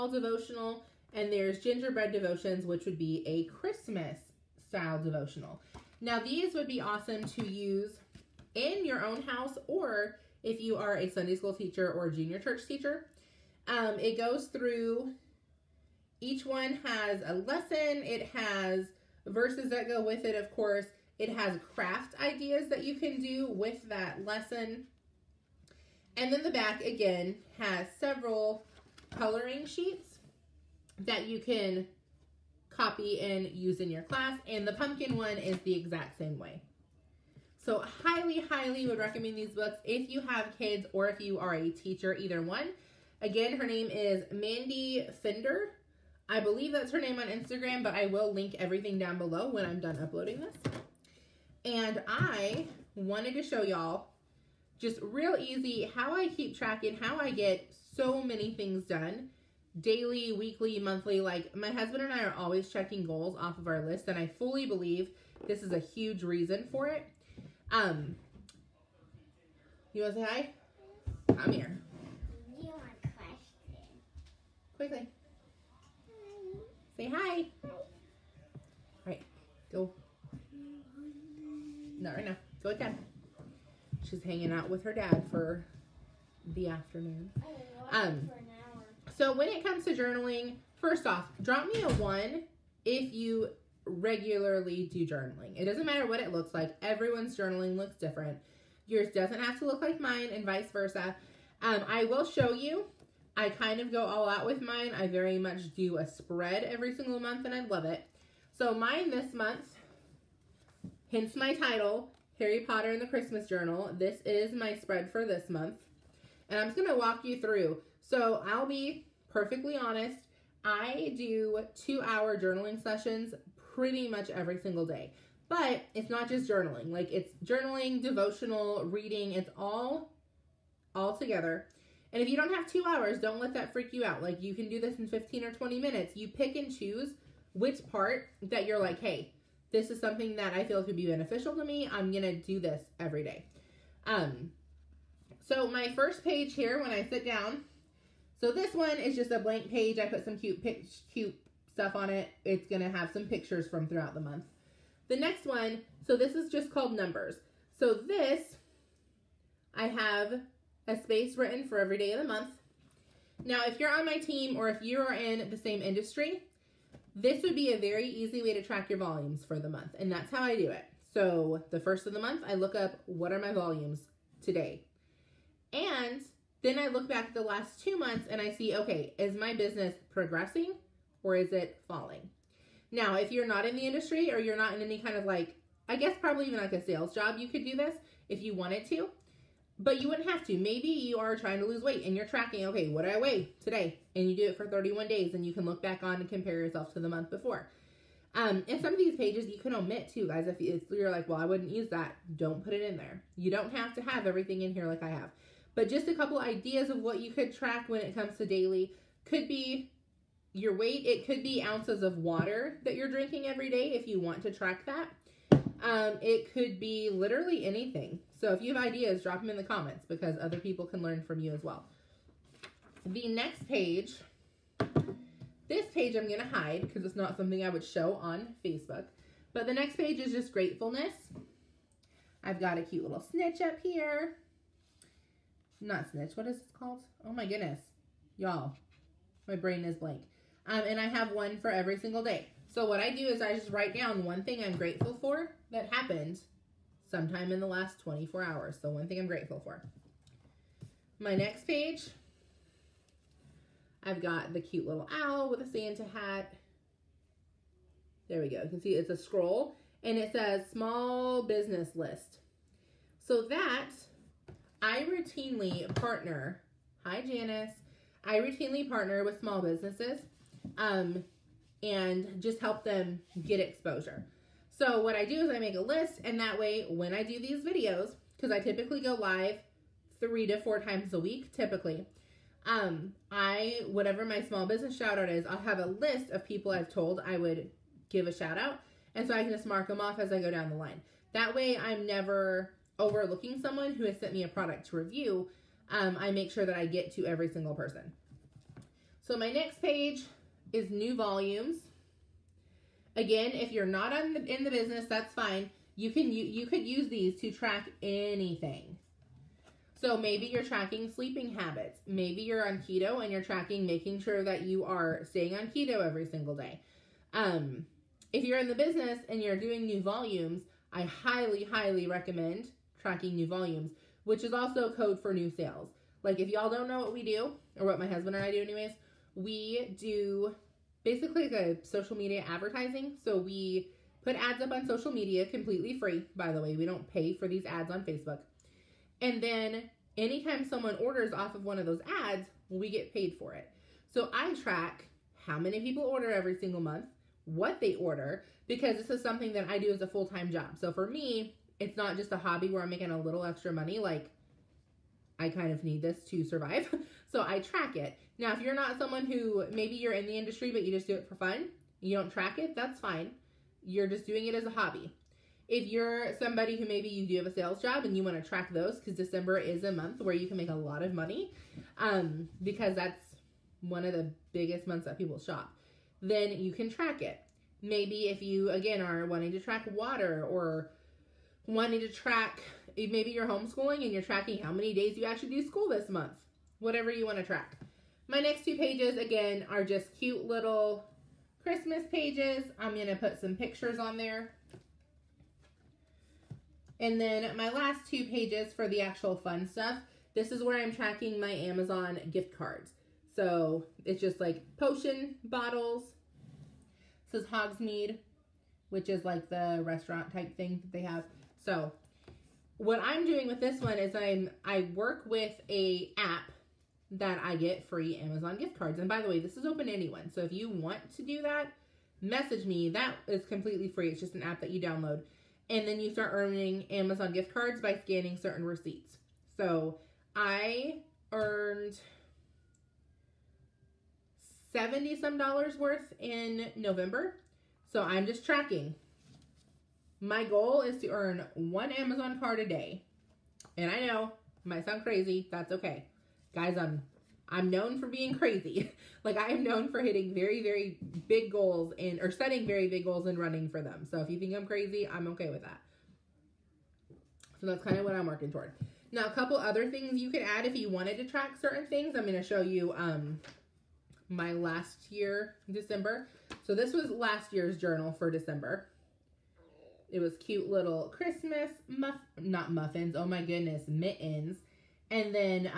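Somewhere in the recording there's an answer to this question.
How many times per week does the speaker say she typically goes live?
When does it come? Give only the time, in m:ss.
4:40.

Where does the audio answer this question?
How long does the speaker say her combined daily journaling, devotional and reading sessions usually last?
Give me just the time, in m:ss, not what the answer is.
2:01.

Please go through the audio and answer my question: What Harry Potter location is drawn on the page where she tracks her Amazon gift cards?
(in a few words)
Hogsmeade.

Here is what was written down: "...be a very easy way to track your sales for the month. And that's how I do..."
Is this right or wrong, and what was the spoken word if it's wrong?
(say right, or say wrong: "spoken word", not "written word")
wrong: "volumes", not "sales".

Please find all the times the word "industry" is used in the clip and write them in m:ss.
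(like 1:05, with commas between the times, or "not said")
2:45, 3:03, 6:00.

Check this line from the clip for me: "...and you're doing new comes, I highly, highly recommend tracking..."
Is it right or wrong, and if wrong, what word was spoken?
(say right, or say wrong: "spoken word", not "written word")
wrong: "volumes", not "comes".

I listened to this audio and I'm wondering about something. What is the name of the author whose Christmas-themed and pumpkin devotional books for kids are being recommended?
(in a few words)
Mandy Fender.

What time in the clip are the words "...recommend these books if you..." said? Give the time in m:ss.
0:38.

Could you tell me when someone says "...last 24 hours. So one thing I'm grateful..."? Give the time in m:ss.
4:07.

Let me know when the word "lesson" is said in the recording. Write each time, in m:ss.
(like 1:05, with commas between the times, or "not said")
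0:17, 0:24.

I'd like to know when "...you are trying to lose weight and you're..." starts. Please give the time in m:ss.
3:10.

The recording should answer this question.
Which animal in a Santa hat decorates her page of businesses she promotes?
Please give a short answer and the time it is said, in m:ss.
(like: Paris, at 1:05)
Owl, at 4:15.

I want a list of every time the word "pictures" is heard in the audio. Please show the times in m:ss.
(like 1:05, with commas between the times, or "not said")
2:33, 6:33.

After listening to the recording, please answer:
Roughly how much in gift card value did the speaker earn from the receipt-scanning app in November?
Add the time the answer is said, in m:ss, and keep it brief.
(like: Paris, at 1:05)
70 some dollars, at 7:14.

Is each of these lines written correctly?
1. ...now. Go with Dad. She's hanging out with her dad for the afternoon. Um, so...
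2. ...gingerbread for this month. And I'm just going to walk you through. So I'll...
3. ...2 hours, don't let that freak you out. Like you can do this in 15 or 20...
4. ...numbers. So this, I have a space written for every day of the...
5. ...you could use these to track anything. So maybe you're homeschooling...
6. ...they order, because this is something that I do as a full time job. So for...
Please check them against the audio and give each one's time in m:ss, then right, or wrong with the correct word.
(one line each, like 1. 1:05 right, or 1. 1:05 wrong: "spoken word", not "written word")
1. 1:22 right
2. 1:54 wrong: "spread", not "gingerbread"
3. 2:12 right
4. 2:36 right
5. 5:06 wrong: "tracking", not "homeschooling"
6. 5:47 right.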